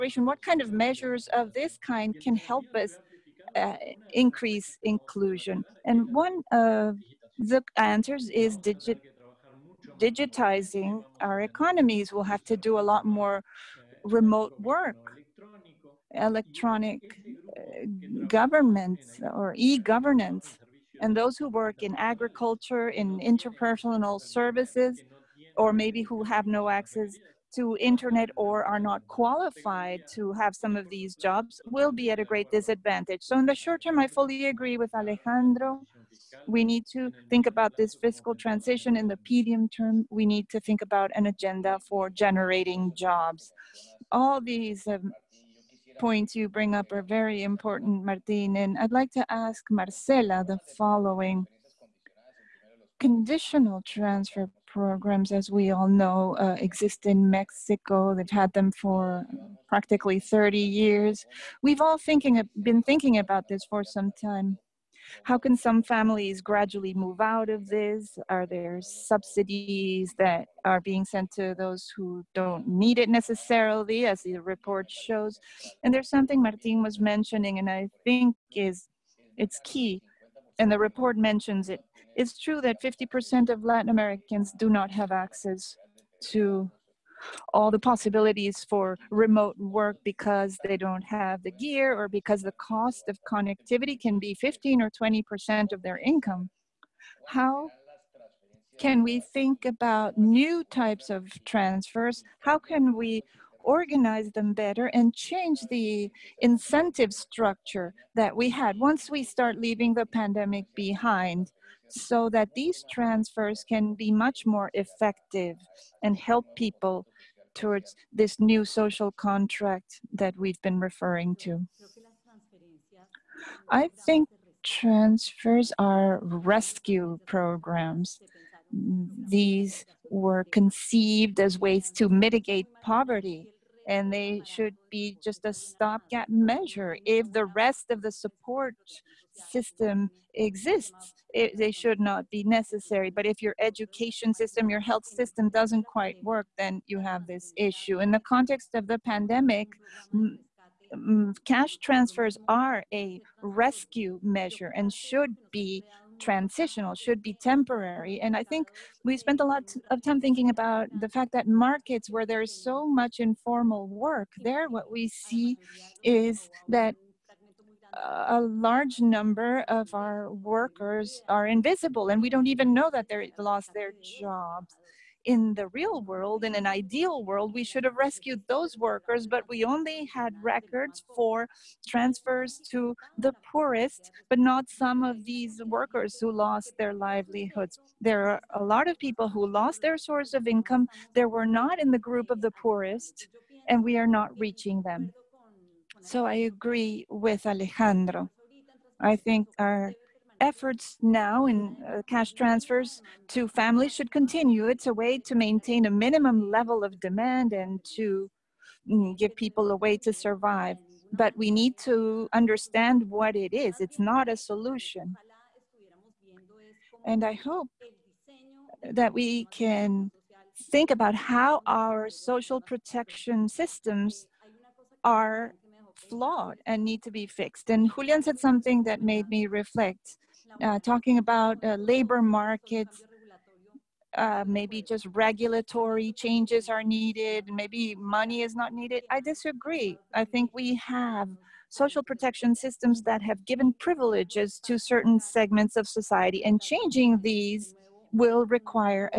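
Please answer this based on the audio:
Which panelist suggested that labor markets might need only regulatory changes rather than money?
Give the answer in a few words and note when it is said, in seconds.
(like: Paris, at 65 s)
Julian, at 227 s.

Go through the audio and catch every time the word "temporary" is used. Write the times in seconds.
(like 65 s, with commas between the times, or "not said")
157 s.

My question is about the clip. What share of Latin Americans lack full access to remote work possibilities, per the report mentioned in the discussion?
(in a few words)
50%.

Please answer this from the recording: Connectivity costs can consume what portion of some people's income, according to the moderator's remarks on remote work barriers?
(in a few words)
15 or 20%.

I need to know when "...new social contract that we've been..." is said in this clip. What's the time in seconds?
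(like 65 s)
118 s.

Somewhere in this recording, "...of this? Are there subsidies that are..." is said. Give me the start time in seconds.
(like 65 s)
67 s.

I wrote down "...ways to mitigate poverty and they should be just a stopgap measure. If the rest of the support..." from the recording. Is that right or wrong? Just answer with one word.
right.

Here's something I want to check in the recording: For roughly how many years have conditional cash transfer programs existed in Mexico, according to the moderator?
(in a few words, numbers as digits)
30.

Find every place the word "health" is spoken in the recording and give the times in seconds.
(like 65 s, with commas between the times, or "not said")
144 s.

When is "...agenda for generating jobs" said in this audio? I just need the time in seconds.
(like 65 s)
41 s.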